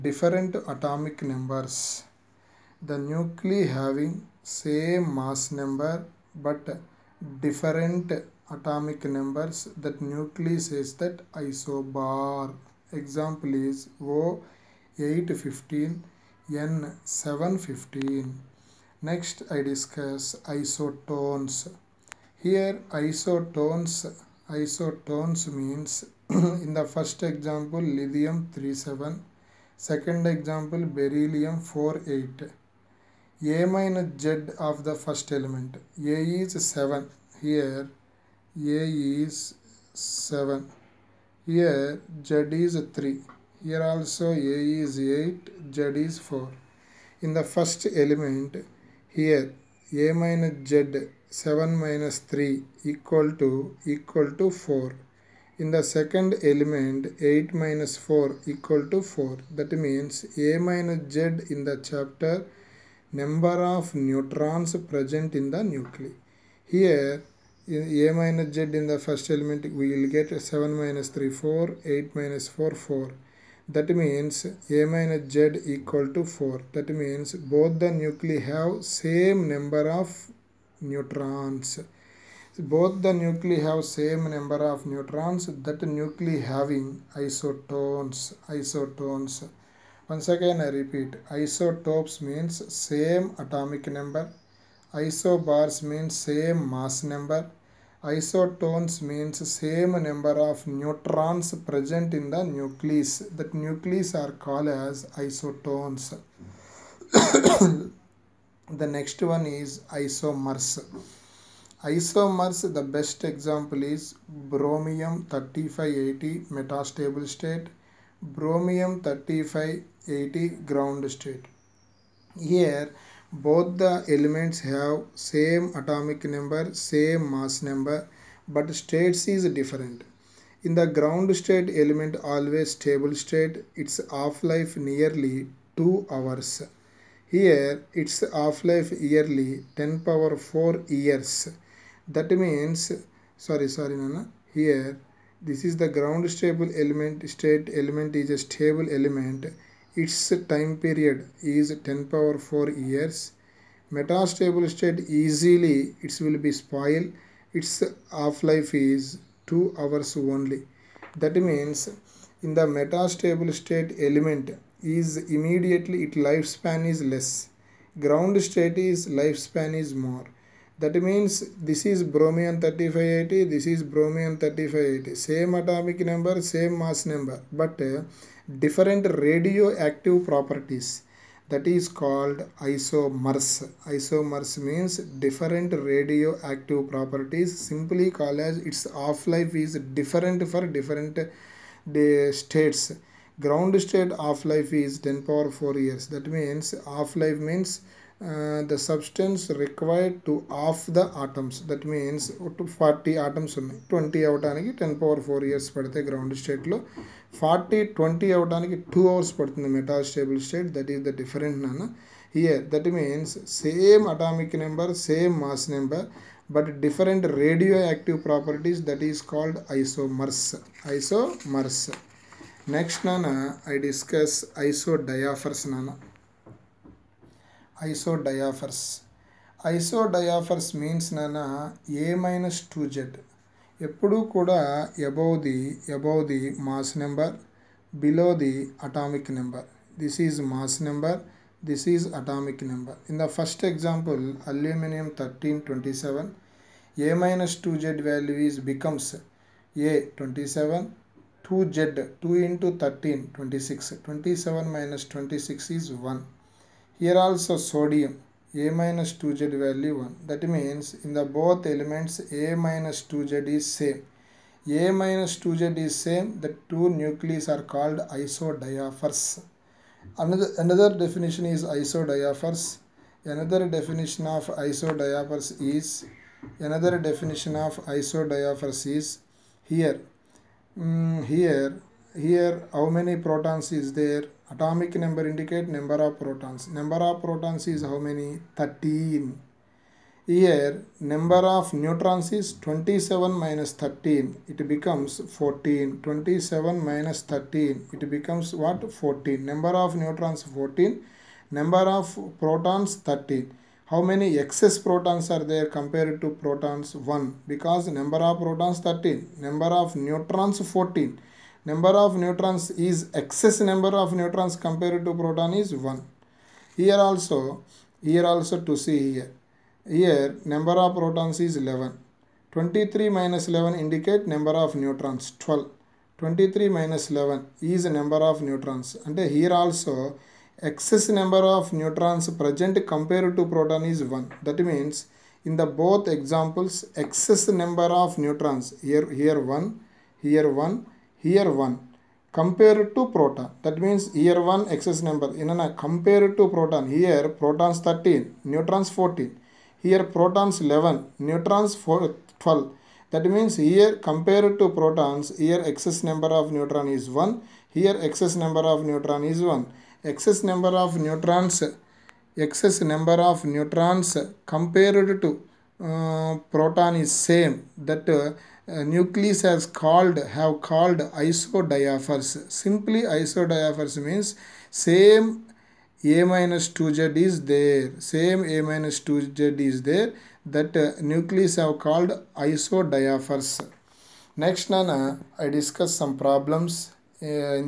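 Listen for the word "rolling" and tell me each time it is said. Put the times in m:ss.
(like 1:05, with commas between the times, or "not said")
not said.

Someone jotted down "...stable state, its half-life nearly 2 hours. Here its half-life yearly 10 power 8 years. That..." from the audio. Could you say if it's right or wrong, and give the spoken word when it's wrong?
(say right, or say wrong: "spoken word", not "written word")
wrong: "4", not "8".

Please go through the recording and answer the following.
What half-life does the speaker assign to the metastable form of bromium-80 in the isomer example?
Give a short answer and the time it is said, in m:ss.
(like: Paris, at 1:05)
2 hours, at 2:39.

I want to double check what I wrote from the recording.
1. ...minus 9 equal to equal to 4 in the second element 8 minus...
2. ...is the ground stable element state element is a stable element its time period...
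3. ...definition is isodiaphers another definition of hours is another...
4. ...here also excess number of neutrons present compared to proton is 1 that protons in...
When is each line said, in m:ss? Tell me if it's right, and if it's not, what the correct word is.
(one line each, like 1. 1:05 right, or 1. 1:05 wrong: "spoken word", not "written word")
1. 0:51 wrong: "3", not "9"
2. 2:25 right
3. 4:31 wrong: "isodiaphers", not "hours"
4. 5:29 wrong: "means", not "protons".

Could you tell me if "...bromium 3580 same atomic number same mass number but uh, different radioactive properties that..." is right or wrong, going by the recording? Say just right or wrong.
right.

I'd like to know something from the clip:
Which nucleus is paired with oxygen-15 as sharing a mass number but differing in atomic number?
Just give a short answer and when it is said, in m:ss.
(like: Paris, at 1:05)
N 715, at 0:16.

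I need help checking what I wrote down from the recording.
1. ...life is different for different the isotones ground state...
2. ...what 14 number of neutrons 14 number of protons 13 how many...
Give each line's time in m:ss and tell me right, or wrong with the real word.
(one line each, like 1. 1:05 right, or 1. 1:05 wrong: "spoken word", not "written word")
1. 3:09 wrong: "states", not "isotones"
2. 4:58 right.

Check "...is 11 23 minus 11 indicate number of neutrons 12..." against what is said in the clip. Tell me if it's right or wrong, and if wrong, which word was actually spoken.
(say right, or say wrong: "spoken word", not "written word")
right.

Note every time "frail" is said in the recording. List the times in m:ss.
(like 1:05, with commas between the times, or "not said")
not said.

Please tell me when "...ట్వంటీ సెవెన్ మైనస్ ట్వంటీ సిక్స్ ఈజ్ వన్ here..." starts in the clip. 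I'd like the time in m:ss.
4:14.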